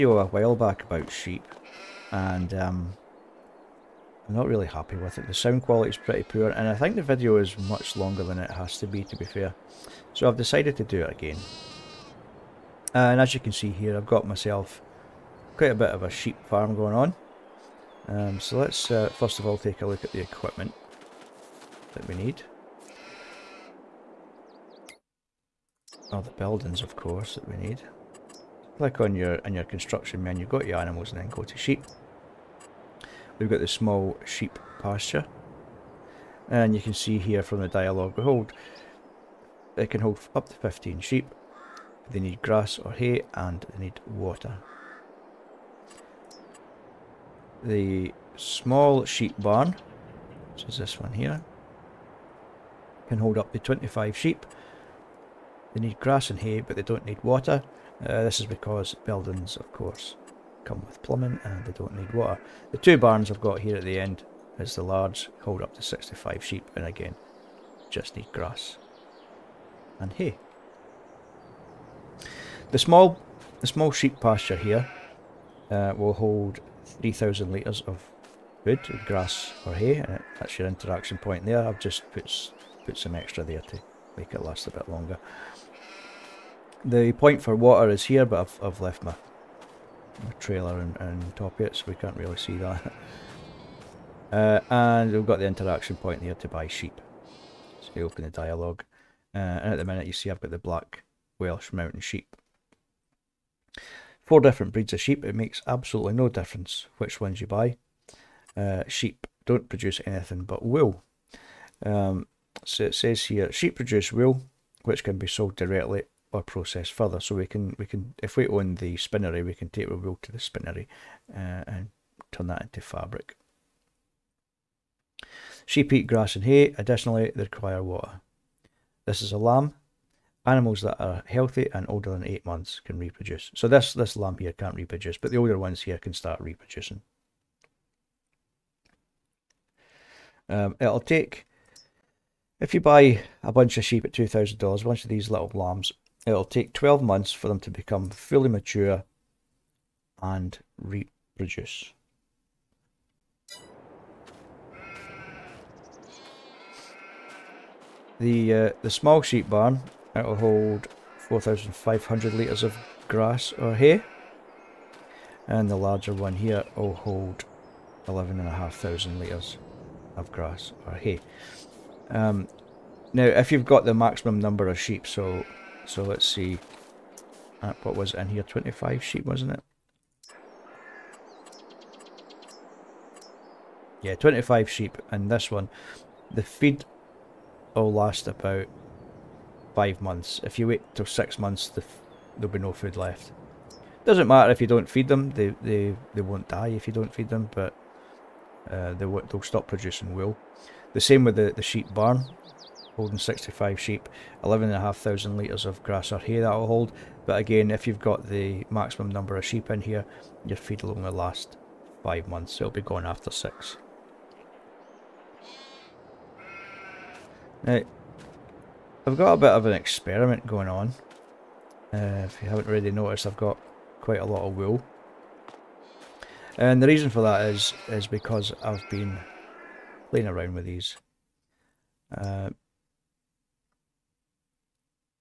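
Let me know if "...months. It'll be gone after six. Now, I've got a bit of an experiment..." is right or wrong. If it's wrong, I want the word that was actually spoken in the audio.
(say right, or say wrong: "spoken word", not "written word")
right.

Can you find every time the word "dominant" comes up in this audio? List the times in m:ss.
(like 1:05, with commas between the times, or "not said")
not said.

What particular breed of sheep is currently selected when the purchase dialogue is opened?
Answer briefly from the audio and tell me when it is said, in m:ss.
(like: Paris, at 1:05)
Black Welsh Mountain, at 1:40.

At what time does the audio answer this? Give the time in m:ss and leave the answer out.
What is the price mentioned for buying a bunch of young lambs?
2:24.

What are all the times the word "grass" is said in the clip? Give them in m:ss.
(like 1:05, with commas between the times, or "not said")
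0:42, 0:55, 1:08, 1:19, 2:06, 2:43, 2:50, 3:25.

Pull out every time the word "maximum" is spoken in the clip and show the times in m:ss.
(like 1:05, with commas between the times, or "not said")
2:53, 3:28.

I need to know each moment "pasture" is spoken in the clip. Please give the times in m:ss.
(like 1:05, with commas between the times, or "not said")
0:34, 1:14.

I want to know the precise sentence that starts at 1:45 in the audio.
It makes absolutely no difference which ones you buy.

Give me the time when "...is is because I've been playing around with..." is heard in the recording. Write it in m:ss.
3:47.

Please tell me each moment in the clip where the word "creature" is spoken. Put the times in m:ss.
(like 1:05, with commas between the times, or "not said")
not said.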